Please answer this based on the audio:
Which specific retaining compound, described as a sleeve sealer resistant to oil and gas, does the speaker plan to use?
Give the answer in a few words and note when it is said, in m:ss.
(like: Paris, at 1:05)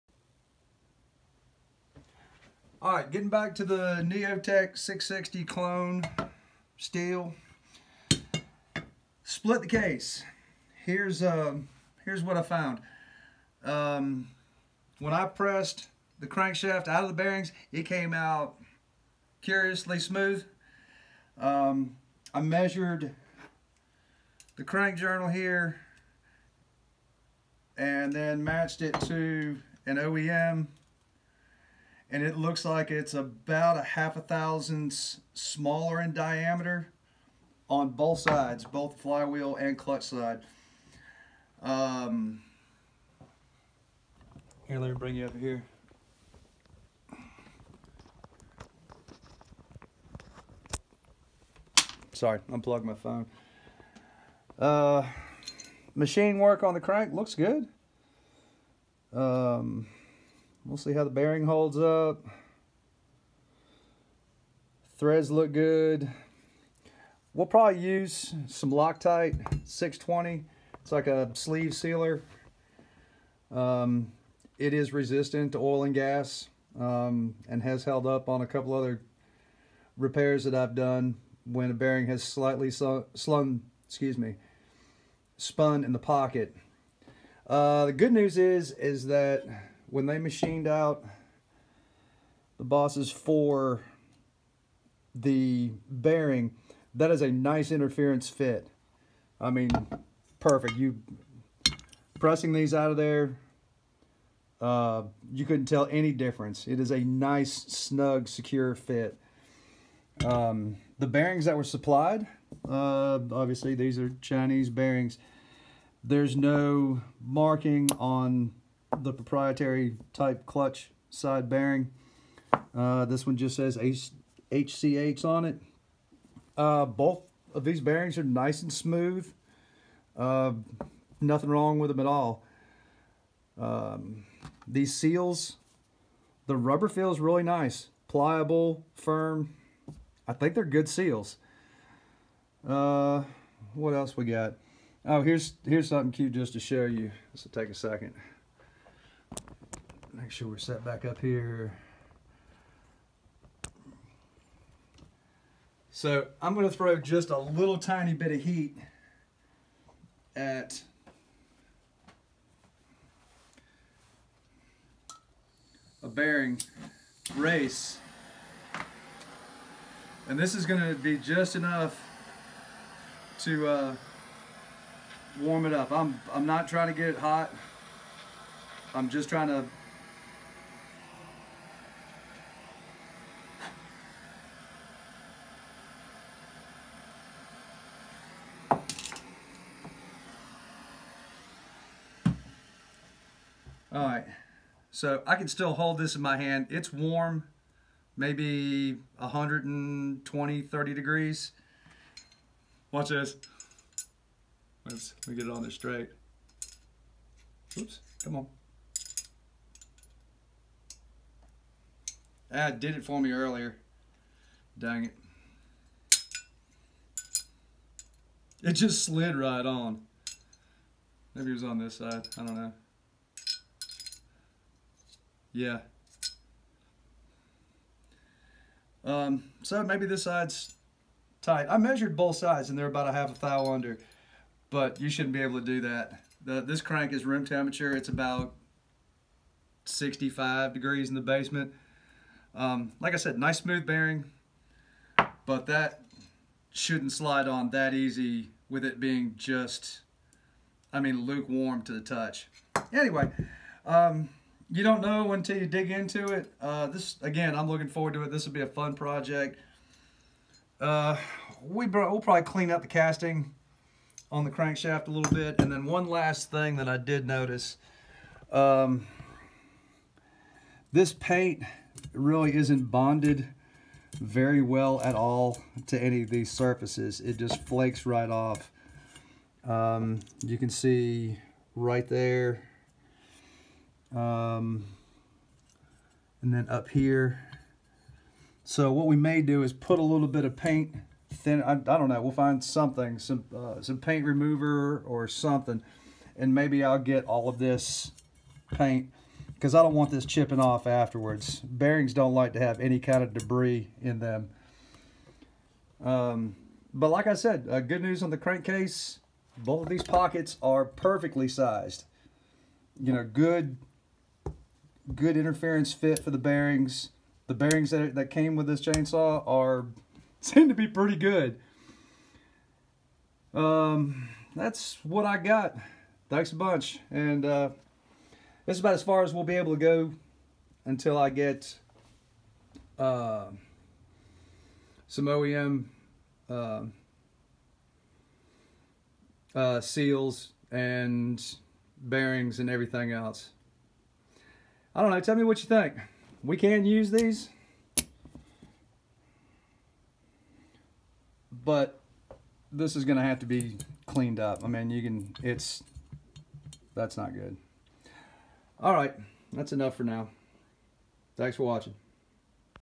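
Loctite 620, at 1:08.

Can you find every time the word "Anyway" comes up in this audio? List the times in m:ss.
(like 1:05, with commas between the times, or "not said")
4:12.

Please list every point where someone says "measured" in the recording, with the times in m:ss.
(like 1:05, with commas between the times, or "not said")
0:22, 3:51.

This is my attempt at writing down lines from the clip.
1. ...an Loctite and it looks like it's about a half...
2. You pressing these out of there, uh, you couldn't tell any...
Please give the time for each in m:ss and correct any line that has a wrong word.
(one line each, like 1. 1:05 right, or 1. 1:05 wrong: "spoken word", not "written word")
1. 0:29 wrong: "OEM", not "Loctite"
2. 1:40 right.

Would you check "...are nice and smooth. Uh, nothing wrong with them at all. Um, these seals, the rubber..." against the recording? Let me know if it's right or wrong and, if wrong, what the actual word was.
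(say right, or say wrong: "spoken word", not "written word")
right.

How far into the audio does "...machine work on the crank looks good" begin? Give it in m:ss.
0:55.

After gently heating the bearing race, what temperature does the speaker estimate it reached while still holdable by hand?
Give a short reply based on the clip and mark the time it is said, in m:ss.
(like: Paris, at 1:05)
120-130 degrees, at 3:19.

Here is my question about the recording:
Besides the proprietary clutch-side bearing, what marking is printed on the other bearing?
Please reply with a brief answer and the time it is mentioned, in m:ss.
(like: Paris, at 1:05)
HCH, at 2:04.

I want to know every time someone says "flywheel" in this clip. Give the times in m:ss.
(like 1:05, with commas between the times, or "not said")
0:38.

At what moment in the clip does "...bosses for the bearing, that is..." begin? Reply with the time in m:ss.
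1:32.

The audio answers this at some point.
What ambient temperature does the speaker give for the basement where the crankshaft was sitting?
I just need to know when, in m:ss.
3:59.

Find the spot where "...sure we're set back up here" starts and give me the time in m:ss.
2:30.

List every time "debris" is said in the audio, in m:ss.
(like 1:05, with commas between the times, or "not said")
5:03.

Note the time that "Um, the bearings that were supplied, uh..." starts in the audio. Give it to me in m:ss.
1:50.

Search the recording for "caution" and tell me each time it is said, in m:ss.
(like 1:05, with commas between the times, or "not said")
not said.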